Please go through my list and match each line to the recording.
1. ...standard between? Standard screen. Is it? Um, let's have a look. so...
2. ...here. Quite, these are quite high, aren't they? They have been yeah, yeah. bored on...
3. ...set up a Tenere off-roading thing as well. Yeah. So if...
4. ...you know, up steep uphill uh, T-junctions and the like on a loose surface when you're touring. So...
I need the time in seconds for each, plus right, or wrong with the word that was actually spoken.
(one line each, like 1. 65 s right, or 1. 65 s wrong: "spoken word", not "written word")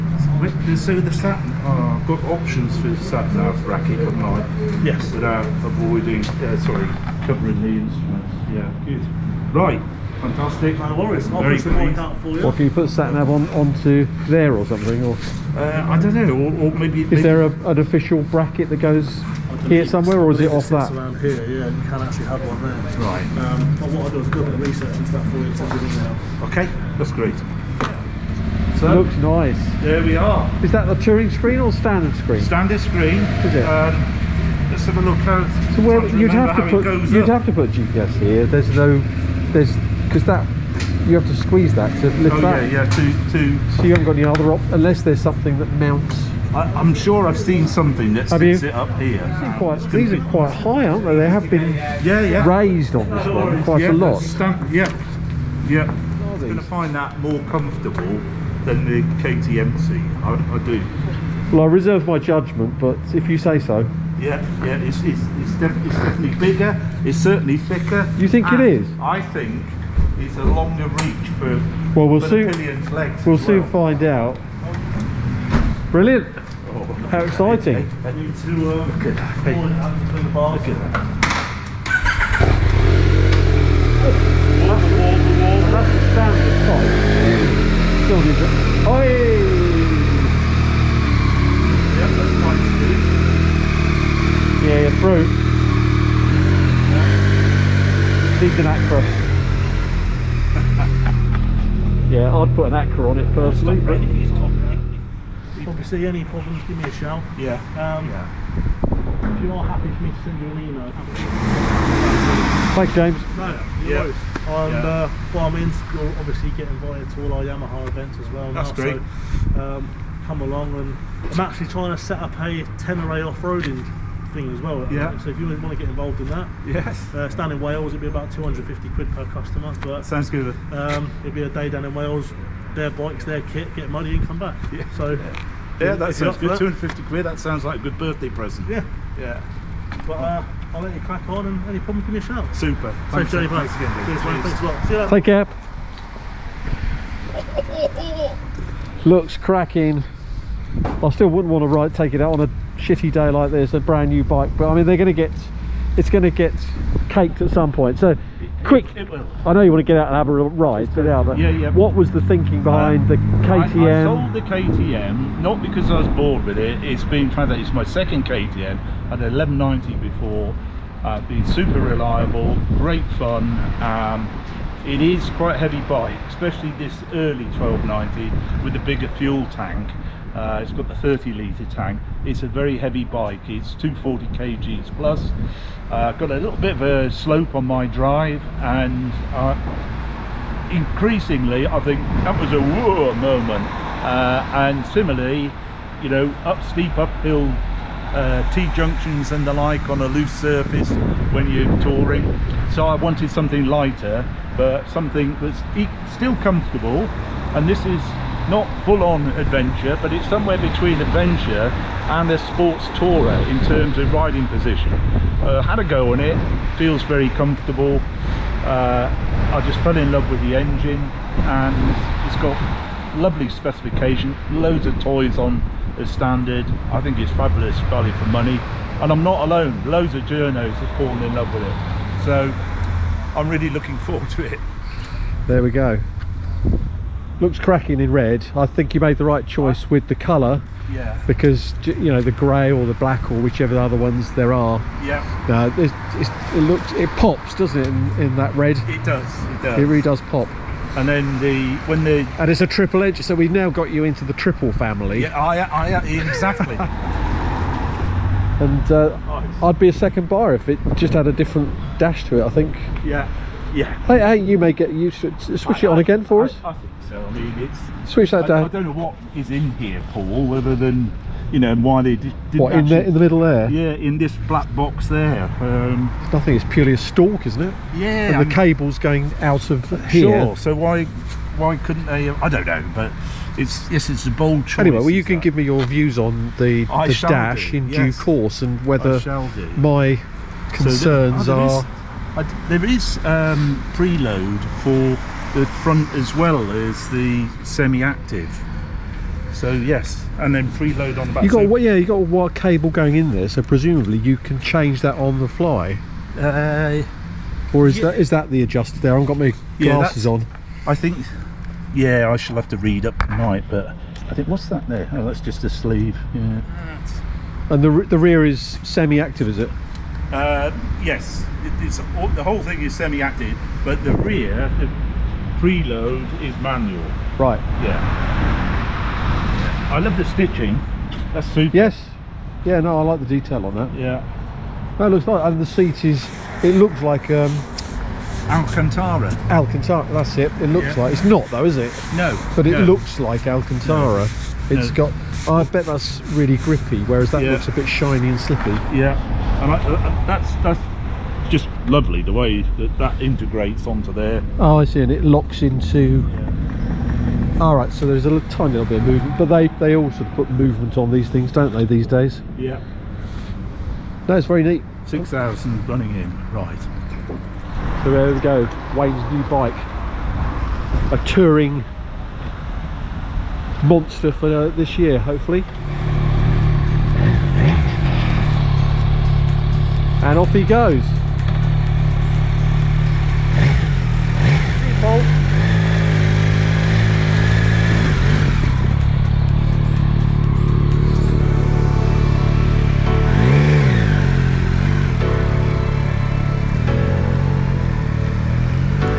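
1. 31 s wrong: "screen", not "between"
2. 48 s wrong: "raised", not "bored"
3. 122 s right
4. 196 s right.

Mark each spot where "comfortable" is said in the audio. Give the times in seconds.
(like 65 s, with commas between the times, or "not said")
57 s, 206 s, 217 s.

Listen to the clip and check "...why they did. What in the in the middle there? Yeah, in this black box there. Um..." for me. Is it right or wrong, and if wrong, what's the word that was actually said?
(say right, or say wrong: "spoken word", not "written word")
right.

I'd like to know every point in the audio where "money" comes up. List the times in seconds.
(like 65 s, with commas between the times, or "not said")
133 s, 228 s.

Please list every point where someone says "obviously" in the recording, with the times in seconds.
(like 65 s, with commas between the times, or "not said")
11 s, 116 s.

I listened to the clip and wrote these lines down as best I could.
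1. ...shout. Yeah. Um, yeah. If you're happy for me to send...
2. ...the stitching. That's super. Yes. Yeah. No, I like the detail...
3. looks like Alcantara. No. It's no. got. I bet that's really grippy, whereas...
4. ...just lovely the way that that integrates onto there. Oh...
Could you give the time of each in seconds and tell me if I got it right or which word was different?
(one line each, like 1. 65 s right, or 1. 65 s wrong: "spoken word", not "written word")
1. 106 s right
2. 330 s right
3. 342 s right
4. 351 s right.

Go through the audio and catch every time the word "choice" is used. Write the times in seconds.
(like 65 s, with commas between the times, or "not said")
239 s, 284 s.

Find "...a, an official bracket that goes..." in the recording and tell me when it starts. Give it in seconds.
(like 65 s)
17 s.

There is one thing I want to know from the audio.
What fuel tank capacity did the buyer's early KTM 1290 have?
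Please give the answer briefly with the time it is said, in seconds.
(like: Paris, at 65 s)
30 litres, at 180 s.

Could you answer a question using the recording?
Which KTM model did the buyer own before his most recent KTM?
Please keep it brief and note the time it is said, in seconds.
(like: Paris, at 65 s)
1190, at 169 s.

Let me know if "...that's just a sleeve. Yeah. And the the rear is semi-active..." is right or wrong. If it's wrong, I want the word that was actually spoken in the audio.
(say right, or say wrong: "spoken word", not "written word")
right.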